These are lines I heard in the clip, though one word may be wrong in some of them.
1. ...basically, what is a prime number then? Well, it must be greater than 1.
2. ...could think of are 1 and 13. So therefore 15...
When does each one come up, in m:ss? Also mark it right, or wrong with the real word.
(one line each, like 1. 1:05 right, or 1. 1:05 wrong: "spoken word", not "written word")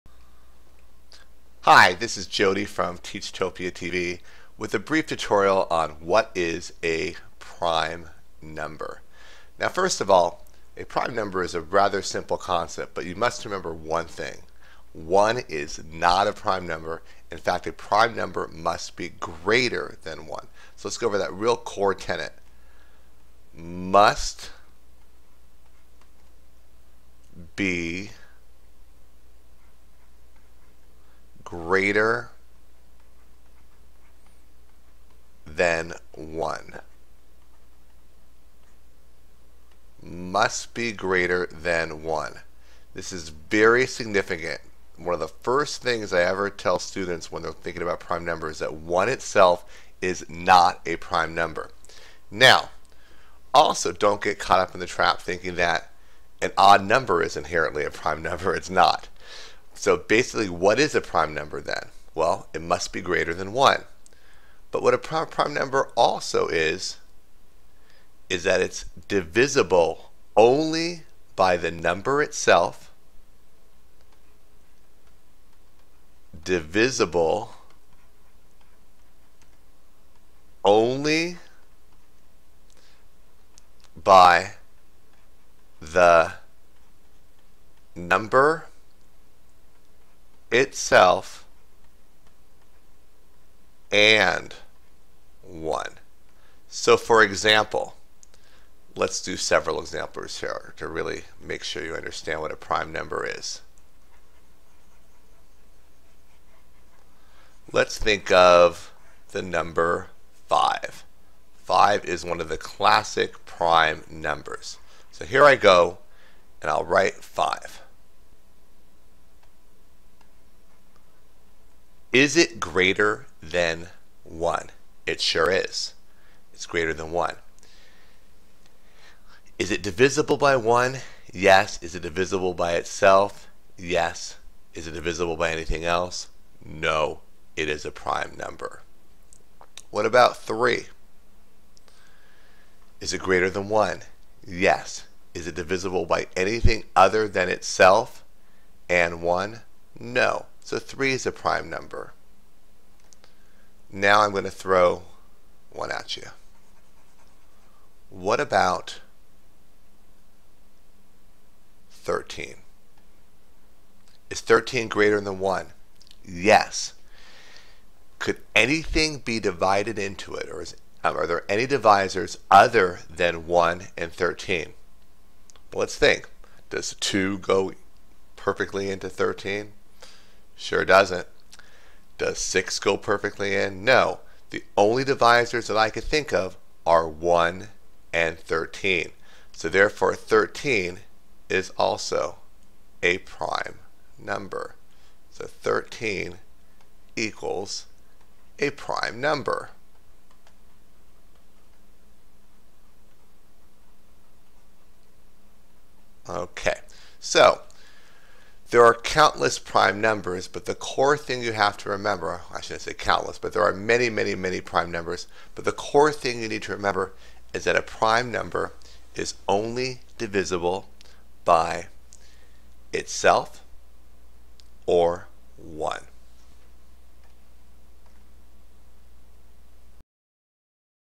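1. 0:59 right
2. 3:05 wrong: "13", not "15".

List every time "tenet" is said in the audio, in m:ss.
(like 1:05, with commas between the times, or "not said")
0:21.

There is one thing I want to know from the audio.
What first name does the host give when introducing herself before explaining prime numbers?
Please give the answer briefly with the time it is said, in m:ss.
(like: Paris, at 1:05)
Jody, at 0:02.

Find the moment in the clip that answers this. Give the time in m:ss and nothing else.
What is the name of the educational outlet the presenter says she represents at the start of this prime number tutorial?
0:02.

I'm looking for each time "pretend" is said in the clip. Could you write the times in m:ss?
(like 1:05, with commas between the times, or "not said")
not said.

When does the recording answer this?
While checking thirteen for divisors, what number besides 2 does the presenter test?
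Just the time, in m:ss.
3:02.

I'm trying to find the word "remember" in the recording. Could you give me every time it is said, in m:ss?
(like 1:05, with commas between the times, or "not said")
0:13, 3:31, 3:36.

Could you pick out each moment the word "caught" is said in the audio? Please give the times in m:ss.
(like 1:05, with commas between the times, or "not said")
0:54.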